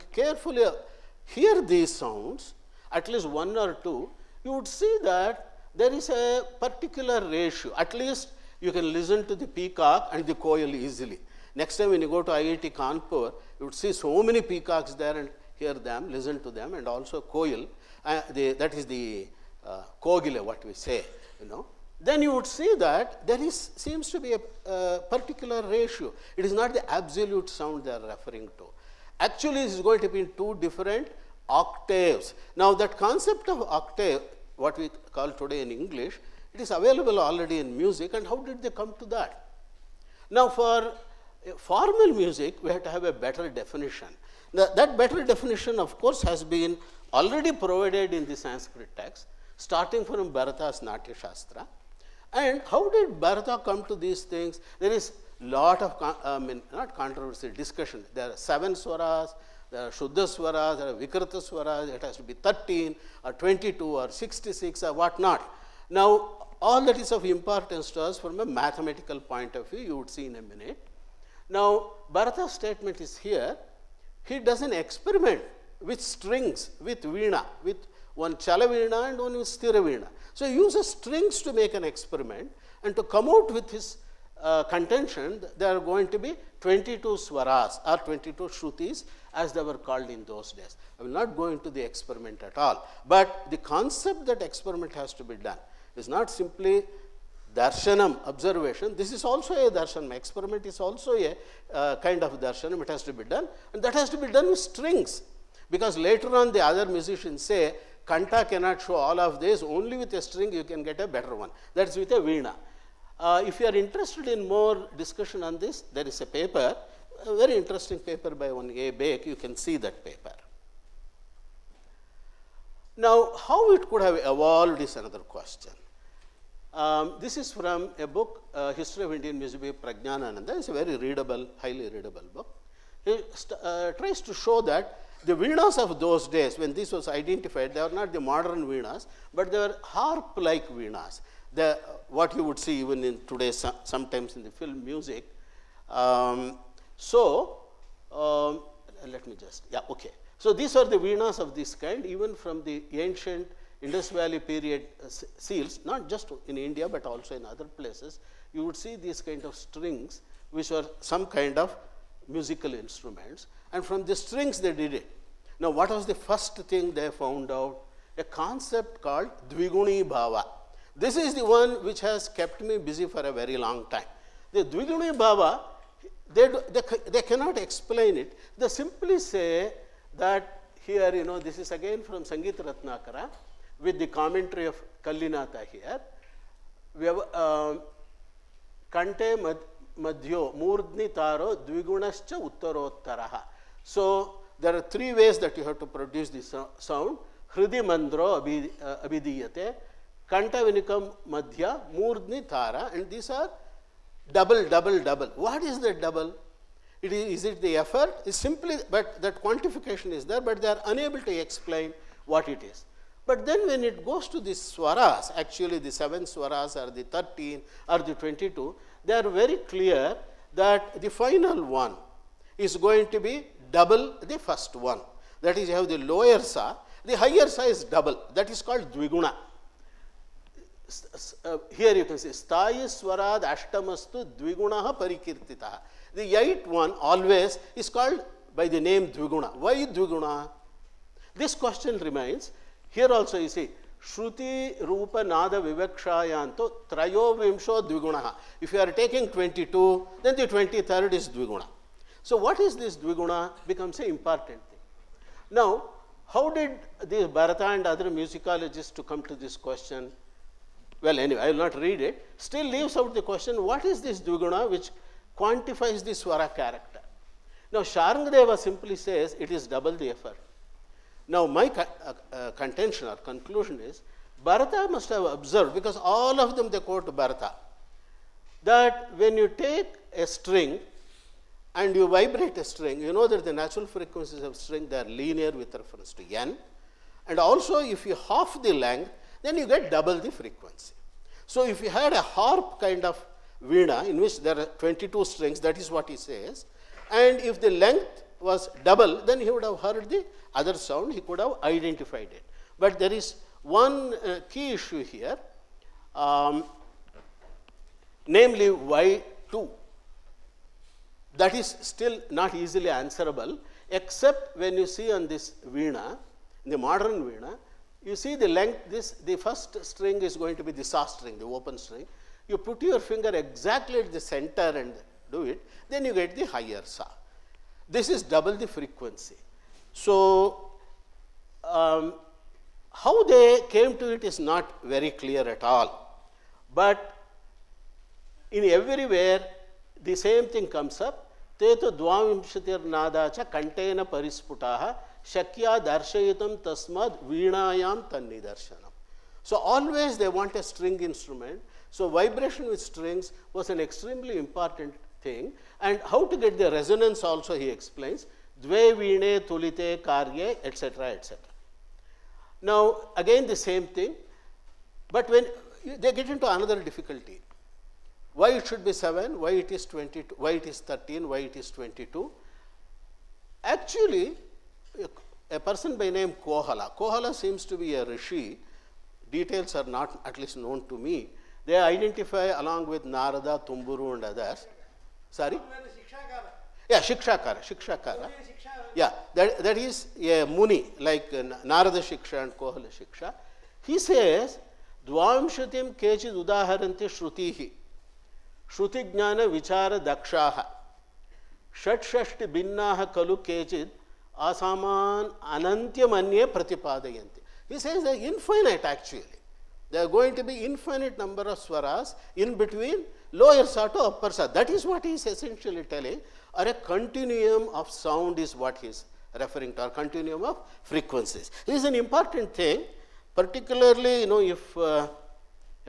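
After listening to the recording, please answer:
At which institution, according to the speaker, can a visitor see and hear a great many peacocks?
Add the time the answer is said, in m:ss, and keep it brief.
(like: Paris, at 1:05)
IIT Kanpur, at 0:12.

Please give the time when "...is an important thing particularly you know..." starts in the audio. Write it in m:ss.
7:01.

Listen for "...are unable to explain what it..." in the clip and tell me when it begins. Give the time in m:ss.
3:30.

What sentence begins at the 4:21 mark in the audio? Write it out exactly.
Well, anyway, I will not read it.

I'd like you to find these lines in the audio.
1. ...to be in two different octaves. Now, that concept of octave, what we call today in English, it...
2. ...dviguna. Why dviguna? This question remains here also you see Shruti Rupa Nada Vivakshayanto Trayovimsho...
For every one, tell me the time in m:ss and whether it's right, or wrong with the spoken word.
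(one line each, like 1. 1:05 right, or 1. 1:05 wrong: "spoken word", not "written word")
1. 0:30 right
2. 3:59 right.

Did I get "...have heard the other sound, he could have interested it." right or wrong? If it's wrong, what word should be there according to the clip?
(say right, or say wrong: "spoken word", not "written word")
wrong: "identified", not "interested".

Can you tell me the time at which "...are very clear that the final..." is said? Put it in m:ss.
3:39.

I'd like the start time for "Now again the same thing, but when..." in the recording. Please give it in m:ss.
6:02.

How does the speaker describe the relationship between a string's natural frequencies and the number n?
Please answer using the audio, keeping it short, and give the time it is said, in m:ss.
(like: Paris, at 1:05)
linear, at 4:45.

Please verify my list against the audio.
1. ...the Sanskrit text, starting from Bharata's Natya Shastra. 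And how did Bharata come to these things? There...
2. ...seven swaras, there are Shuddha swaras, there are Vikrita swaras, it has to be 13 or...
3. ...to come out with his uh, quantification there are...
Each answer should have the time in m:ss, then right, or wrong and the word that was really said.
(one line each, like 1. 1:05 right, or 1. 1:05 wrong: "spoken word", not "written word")
1. 0:48 right
2. 0:58 right
3. 1:22 wrong: "contention", not "quantification".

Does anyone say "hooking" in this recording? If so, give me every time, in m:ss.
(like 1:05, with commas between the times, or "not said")
not said.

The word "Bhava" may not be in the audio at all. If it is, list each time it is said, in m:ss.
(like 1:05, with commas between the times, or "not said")
2:50, 2:55.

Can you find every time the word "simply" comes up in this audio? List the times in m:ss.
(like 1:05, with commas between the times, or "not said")
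1:36, 2:58, 3:28, 4:28.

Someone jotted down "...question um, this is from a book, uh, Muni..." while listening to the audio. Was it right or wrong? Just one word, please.
wrong.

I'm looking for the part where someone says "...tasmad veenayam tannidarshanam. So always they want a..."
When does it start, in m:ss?
5:46.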